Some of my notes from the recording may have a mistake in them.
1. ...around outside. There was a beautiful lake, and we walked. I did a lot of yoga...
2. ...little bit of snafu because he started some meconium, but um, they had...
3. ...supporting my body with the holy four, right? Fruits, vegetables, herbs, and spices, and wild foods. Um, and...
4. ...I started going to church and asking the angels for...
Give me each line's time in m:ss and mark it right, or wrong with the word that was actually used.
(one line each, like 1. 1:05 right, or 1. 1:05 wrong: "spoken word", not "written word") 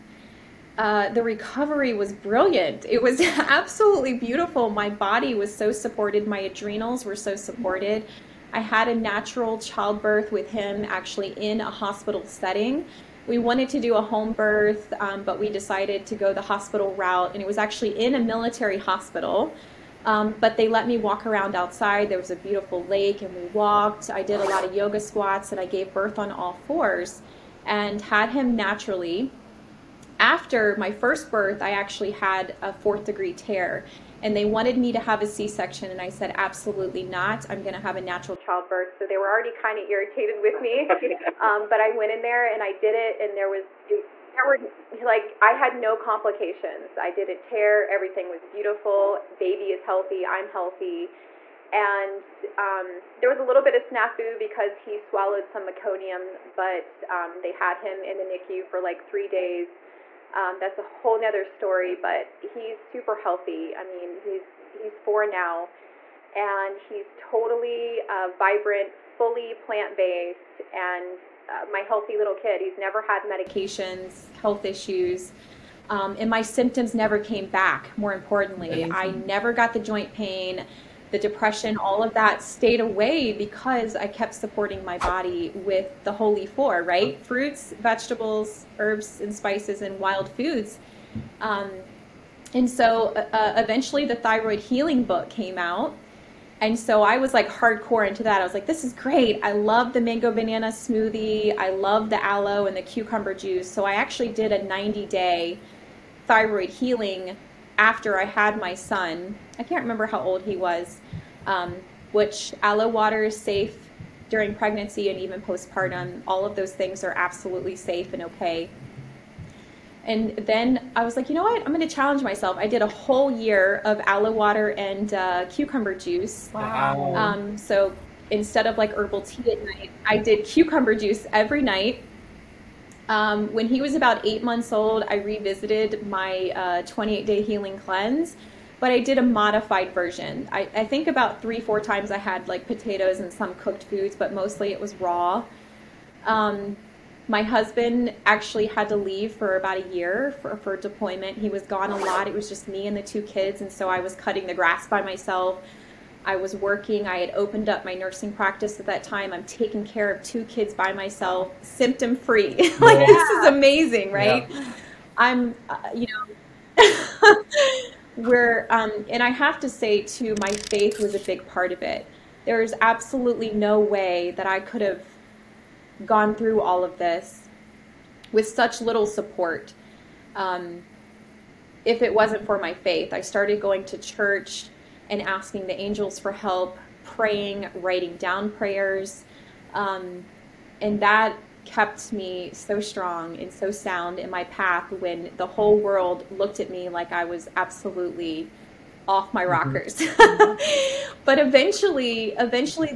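1. 0:21 right
2. 0:53 wrong: "swallowed", not "started"
3. 1:24 right
4. 3:03 right.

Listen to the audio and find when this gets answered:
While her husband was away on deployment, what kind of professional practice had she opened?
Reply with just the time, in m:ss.
2:37.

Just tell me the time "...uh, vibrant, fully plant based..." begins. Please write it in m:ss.
1:08.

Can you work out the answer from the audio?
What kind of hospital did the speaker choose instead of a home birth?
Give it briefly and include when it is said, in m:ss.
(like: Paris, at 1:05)
Military hospital, at 0:18.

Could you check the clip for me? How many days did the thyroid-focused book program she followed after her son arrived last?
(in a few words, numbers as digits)
90.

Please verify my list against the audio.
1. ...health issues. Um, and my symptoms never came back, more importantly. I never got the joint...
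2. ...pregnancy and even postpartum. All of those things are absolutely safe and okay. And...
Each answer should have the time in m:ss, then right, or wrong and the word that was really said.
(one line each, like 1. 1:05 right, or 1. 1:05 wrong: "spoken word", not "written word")
1. 1:14 right
2. 1:54 right.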